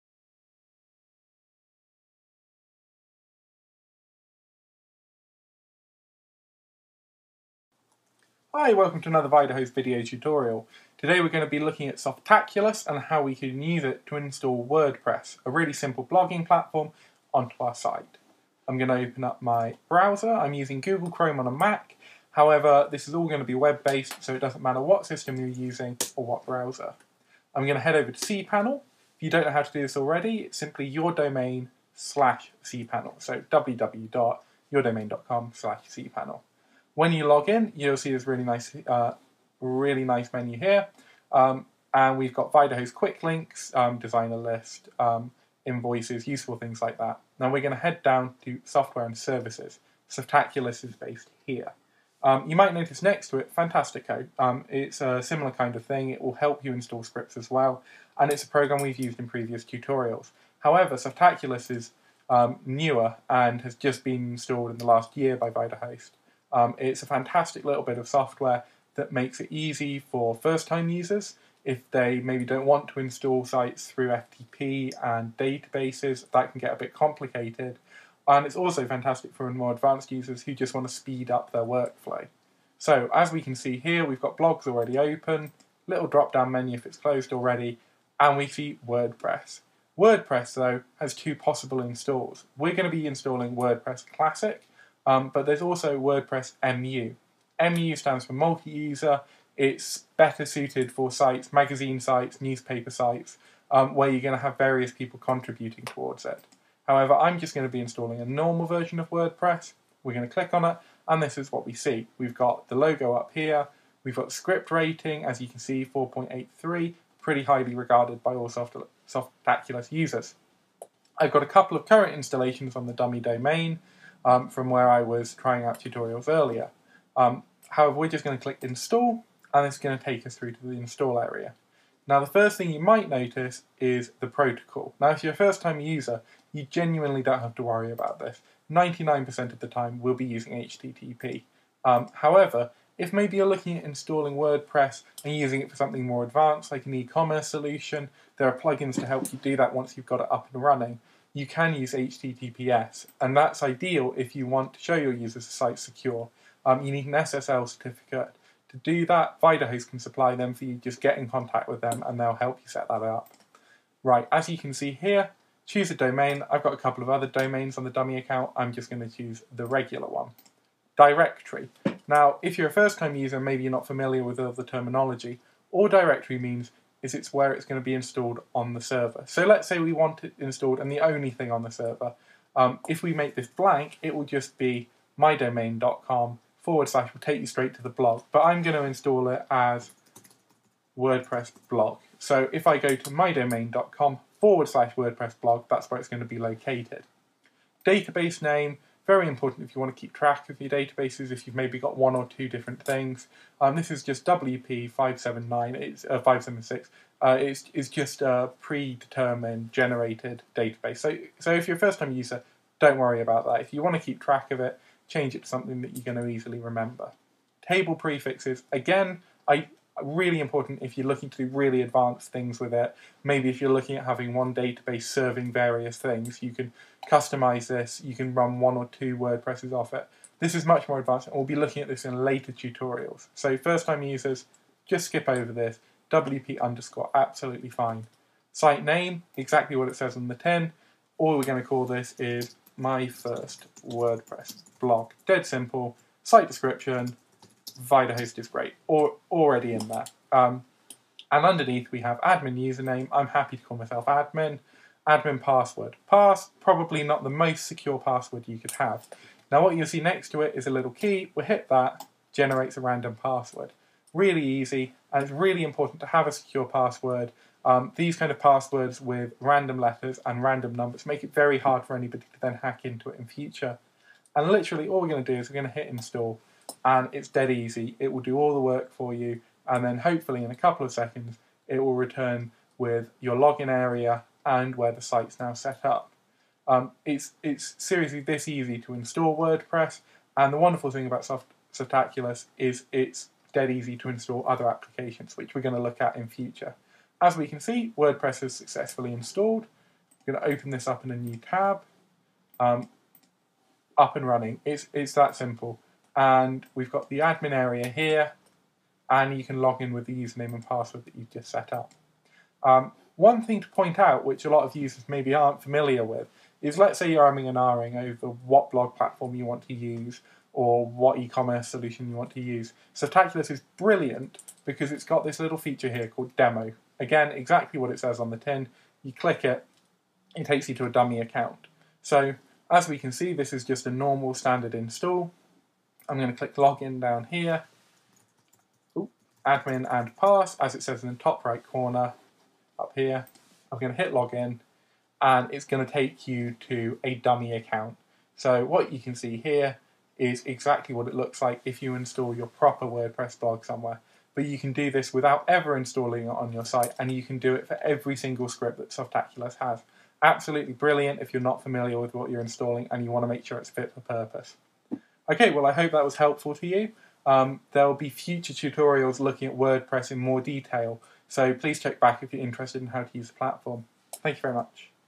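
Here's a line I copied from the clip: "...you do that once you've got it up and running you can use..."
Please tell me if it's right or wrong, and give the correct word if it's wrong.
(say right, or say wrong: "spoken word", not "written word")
right.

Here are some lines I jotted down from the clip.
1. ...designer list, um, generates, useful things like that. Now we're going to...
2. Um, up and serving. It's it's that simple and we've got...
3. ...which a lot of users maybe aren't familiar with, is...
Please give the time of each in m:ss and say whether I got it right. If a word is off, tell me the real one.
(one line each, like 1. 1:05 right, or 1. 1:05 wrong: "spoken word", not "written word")
1. 0:43 wrong: "invoices", not "generates"
2. 5:02 wrong: "running", not "serving"
3. 5:14 right.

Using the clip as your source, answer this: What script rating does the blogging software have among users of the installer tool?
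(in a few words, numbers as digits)
4.83.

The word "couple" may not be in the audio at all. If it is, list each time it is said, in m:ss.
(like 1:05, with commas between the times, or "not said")
2:01, 2:46, 4:40.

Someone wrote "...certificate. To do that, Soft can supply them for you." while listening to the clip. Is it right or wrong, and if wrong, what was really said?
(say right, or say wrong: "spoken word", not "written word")
wrong: "Vidahost", not "Soft".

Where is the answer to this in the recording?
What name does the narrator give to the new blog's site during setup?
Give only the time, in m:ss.
4:02.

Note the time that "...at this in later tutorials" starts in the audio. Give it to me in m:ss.
3:51.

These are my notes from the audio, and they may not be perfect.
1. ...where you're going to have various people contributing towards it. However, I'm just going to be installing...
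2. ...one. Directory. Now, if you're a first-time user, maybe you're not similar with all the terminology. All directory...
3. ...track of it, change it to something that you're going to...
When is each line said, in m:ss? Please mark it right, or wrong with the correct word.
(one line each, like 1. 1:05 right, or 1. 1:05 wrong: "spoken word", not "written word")
1. 1:43 right
2. 2:50 wrong: "familiar", not "similar"
3. 3:34 right.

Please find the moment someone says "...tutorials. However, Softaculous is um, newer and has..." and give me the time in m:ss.
0:59.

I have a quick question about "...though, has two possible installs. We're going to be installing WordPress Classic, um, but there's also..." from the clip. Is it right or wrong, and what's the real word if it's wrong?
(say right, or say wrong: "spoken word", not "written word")
right.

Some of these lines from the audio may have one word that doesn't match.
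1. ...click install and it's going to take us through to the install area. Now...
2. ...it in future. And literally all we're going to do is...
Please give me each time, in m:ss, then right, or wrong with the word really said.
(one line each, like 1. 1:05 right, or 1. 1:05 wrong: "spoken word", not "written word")
1. 2:08 right
2. 4:33 right.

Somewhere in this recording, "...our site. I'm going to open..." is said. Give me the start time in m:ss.
0:17.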